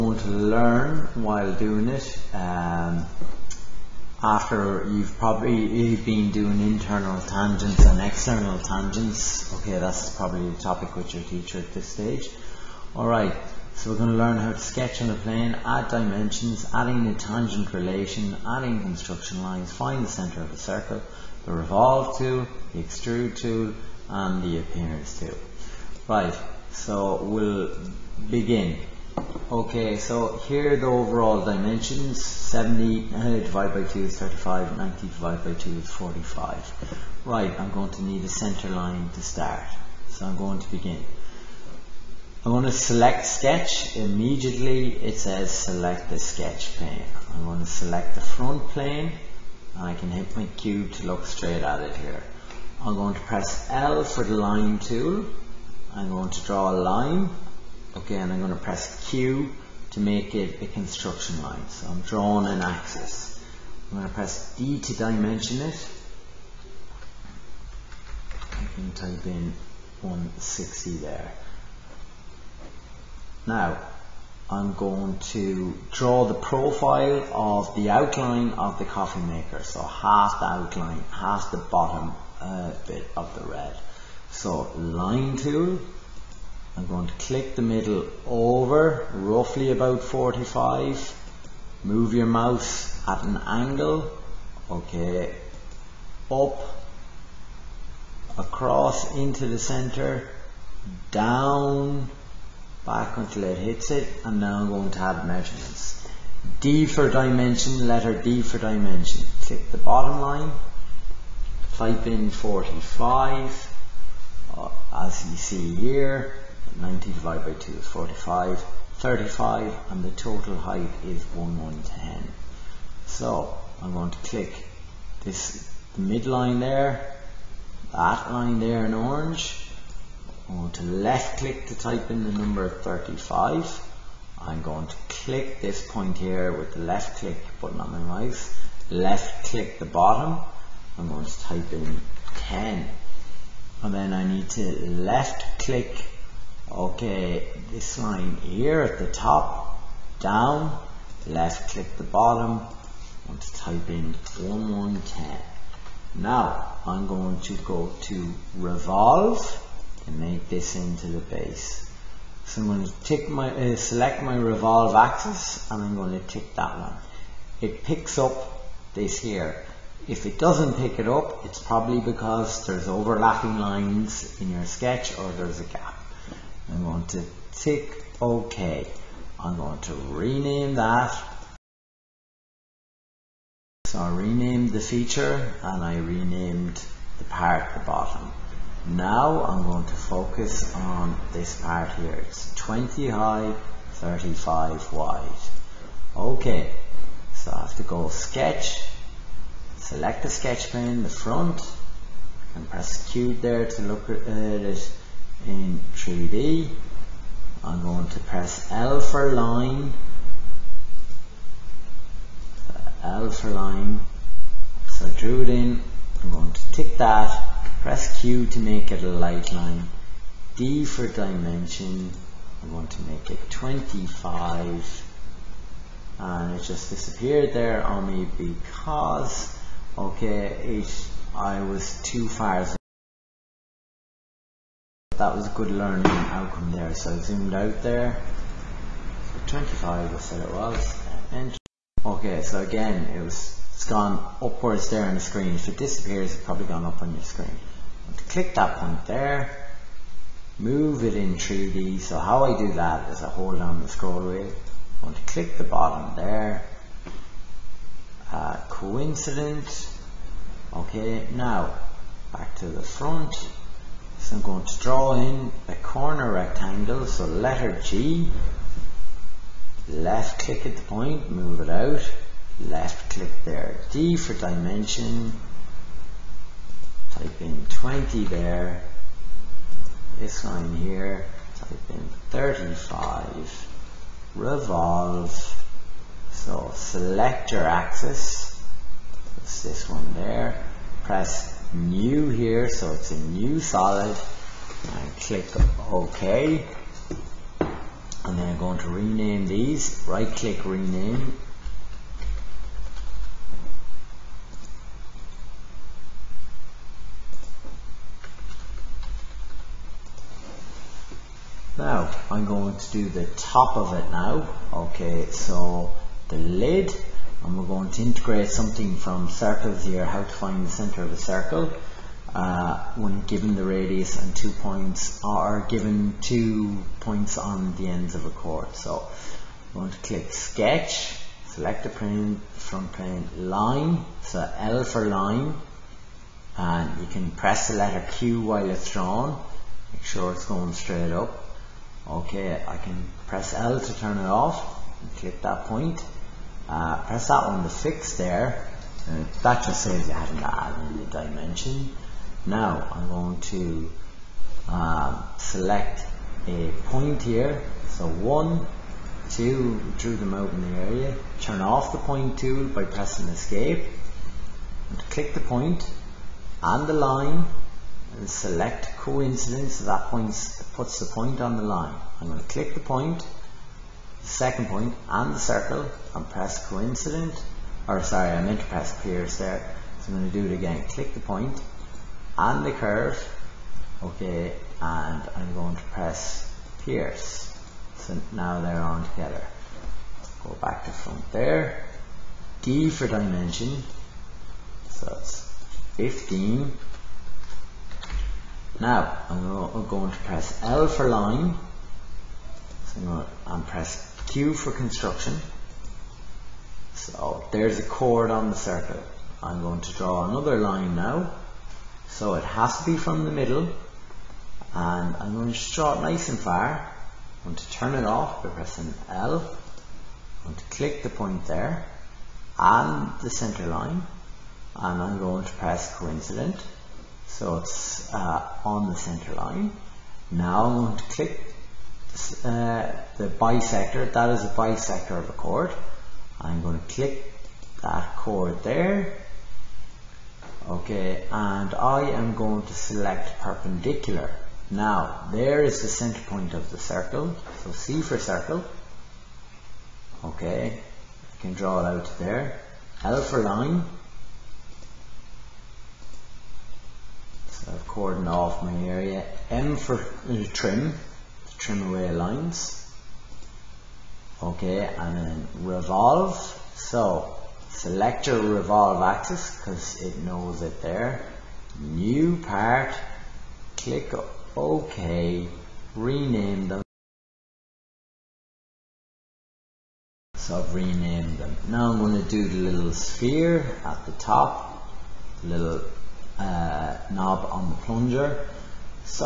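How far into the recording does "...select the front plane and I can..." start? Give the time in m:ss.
0:47.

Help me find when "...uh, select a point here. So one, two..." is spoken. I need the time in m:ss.
5:54.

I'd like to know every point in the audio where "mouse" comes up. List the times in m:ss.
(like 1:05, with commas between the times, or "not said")
1:32, 2:18.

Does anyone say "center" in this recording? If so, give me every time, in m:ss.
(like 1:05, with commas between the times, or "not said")
0:20, 0:38, 1:39, 5:20, 7:03, 7:08, 7:25.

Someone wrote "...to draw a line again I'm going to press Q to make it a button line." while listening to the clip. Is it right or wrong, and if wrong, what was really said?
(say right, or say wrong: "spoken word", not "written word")
wrong: "construction", not "button".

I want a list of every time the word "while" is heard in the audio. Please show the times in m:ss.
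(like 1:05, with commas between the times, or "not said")
0:01, 5:38.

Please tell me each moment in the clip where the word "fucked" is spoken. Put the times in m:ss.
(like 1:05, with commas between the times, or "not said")
not said.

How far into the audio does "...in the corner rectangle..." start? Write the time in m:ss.
4:25.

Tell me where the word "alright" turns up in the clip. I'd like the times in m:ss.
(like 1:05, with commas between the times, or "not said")
0:12.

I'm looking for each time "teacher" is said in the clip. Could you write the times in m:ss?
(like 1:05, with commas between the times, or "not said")
0:11.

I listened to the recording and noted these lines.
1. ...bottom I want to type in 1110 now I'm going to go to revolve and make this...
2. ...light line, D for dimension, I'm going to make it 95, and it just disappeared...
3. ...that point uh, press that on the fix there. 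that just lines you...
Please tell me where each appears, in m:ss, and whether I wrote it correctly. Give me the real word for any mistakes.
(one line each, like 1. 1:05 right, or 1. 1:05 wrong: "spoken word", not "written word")
1. 2:32 right
2. 3:39 wrong: "25", not "95"
3. 5:45 wrong: "saves", not "lines".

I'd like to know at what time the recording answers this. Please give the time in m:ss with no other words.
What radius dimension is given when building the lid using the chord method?
6:35.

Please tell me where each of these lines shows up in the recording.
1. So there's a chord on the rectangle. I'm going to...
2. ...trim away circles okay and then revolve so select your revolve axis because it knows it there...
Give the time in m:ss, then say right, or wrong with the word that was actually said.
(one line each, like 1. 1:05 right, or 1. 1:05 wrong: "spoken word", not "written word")
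1. 6:46 wrong: "circle", not "rectangle"
2. 7:41 wrong: "lines", not "circles".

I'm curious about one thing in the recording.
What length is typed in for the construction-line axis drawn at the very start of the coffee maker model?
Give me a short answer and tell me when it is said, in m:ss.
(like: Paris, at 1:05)
160, at 1:10.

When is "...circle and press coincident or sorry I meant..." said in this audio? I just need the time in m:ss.
6:15.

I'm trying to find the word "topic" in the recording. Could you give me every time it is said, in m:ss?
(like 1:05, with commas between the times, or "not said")
0:10.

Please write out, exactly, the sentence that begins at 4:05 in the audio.
If it disappears, it's probably gone up on your screen.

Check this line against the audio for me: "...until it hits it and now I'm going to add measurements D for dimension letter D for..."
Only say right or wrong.
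right.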